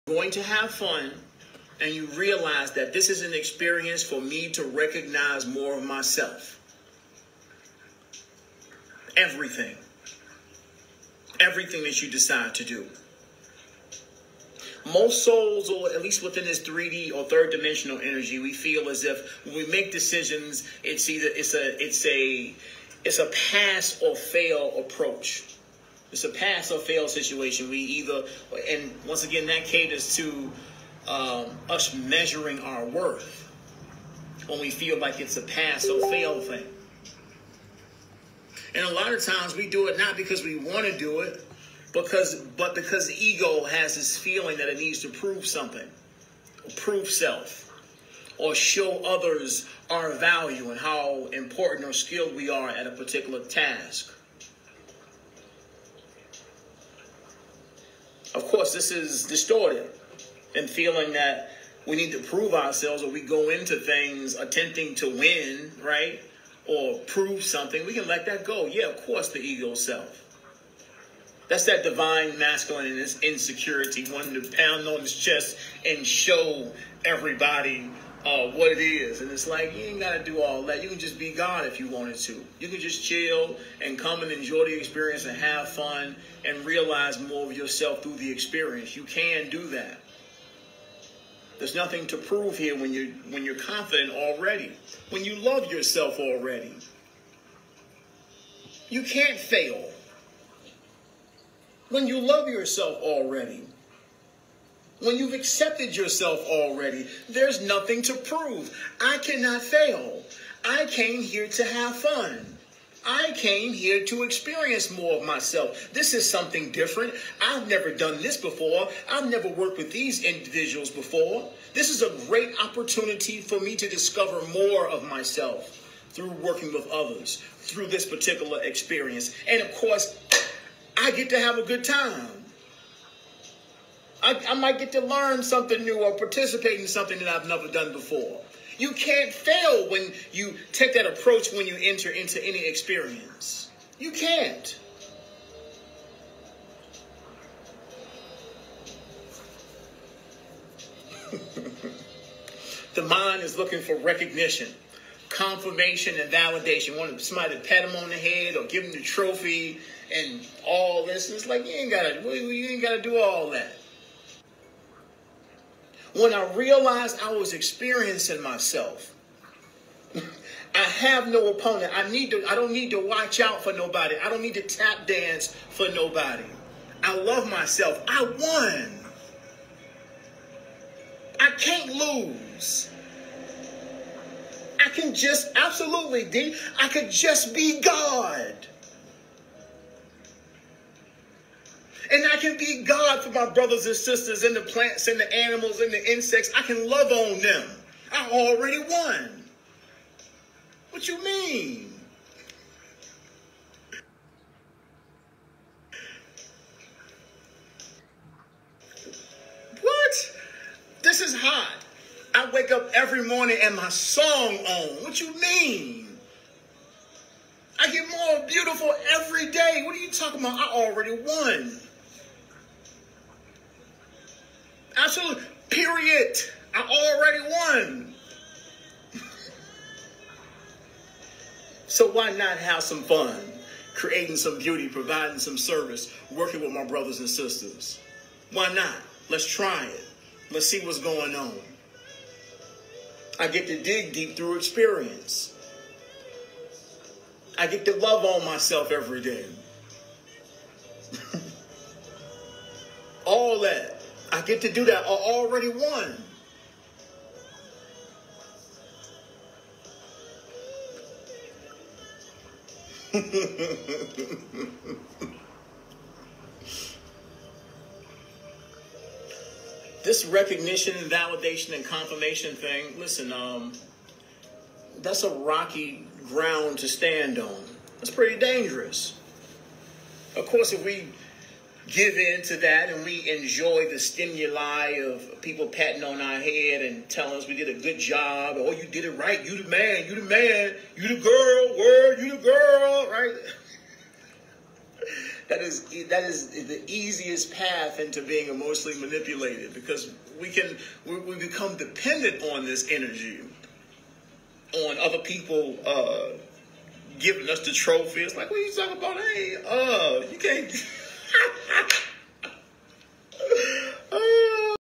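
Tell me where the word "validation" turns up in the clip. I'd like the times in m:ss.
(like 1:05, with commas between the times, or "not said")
2:36, 4:31.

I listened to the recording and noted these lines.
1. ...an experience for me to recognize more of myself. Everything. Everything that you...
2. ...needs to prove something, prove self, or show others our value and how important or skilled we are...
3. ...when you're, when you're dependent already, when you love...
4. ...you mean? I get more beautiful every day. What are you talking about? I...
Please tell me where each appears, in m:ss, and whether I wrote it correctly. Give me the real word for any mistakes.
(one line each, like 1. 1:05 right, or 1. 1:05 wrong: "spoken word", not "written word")
1. 0:03 right
2. 0:44 right
3. 1:32 wrong: "confident", not "dependent"
4. 3:35 right.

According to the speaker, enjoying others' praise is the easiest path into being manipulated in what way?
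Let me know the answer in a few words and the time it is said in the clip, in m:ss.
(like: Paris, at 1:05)
emotionally, at 4:58.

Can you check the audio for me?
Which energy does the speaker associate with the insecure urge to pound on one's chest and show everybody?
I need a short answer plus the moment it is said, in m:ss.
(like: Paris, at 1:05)
divine masculine, at 1:11.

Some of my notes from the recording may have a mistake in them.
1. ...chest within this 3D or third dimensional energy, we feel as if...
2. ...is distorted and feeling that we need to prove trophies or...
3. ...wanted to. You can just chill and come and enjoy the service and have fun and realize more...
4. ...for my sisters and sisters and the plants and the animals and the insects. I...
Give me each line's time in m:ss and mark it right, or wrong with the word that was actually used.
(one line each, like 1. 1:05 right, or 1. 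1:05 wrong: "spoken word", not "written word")
1. 0:16 wrong: "least", not "chest"
2. 0:58 wrong: "ourselves", not "trophies"
3. 1:21 wrong: "experience", not "service"
4. 3:13 wrong: "brothers", not "sisters".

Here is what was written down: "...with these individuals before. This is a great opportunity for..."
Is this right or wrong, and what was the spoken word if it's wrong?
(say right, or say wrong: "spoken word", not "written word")
right.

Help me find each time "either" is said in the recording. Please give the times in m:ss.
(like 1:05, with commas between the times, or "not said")
0:21, 0:27.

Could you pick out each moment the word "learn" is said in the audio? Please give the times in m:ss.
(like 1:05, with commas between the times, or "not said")
2:15.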